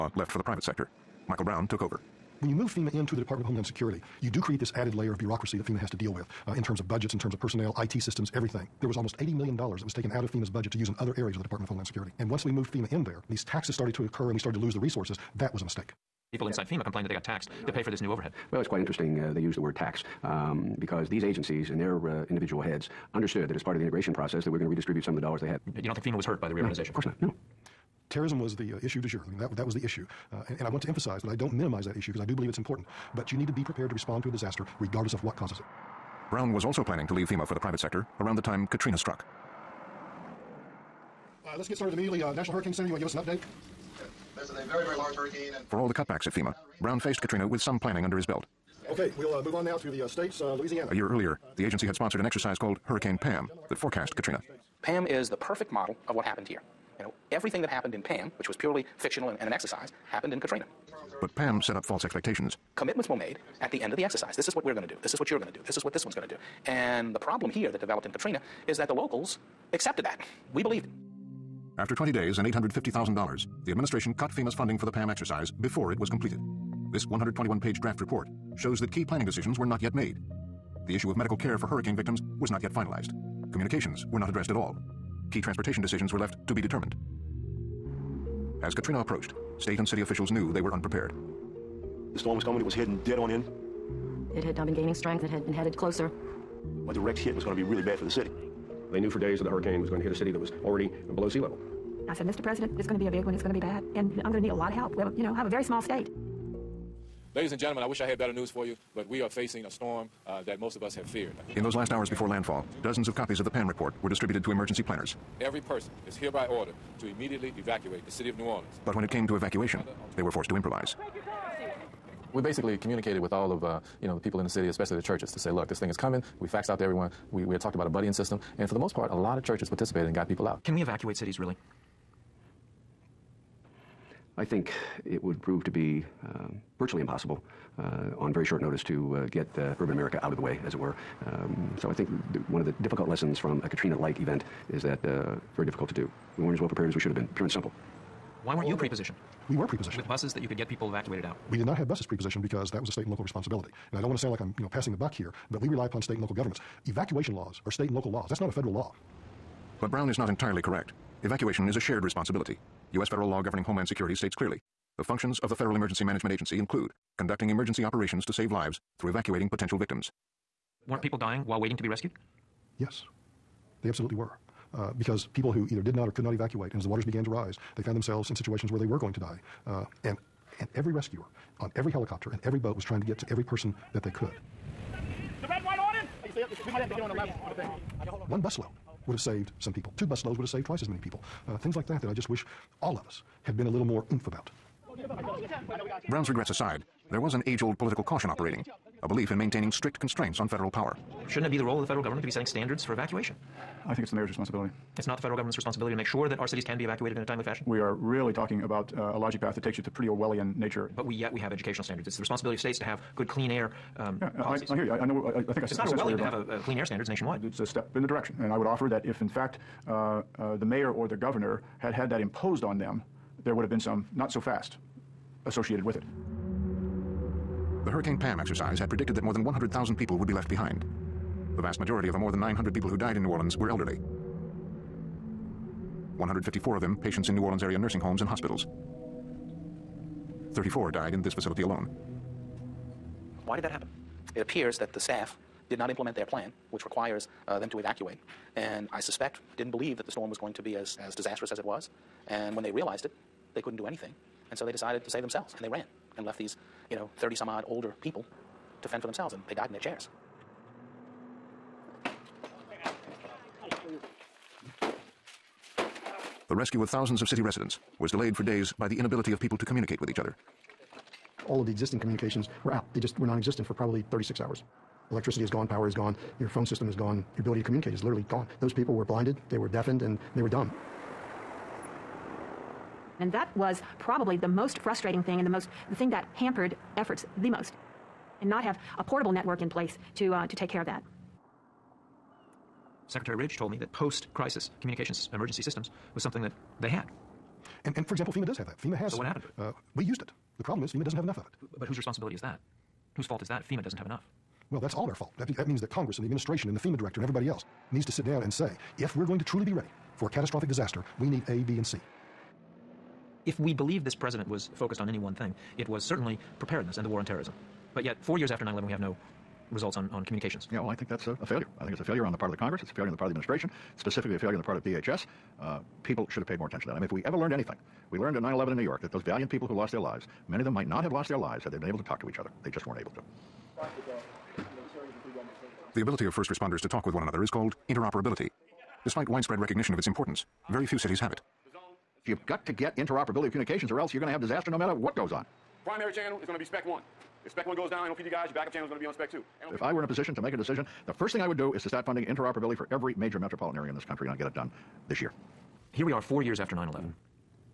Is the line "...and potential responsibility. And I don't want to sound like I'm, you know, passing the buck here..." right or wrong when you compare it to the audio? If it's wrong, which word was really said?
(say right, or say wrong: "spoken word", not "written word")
wrong: "local", not "potential".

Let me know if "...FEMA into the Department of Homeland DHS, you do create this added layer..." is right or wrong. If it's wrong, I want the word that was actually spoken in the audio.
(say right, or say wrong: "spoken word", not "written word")
wrong: "Security", not "DHS".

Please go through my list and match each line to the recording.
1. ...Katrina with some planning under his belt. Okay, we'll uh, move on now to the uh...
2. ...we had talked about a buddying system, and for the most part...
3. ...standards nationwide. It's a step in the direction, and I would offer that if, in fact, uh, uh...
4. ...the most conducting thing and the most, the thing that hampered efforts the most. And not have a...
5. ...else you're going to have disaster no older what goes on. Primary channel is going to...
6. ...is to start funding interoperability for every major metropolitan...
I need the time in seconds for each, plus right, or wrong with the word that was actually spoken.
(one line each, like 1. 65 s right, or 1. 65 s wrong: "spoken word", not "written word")
1. 47 s right
2. 127 s right
3. 216 s right
4. 284 s wrong: "frustrating", not "conducting"
5. 343 s wrong: "matter", not "older"
6. 351 s right.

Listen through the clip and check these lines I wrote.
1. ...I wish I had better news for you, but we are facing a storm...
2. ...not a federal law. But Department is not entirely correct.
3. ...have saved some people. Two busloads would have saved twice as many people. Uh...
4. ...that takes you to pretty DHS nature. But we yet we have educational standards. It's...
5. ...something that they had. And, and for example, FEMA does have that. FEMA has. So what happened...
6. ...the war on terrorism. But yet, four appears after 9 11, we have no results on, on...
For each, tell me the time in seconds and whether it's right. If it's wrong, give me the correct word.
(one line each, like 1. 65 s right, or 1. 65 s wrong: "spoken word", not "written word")
1. 107 s right
2. 158 s wrong: "Brown", not "Department"
3. 189 s right
4. 209 s wrong: "Orwellian", not "DHS"
5. 296 s right
6. 317 s wrong: "years", not "appears".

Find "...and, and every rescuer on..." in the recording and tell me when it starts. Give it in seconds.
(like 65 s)
180 s.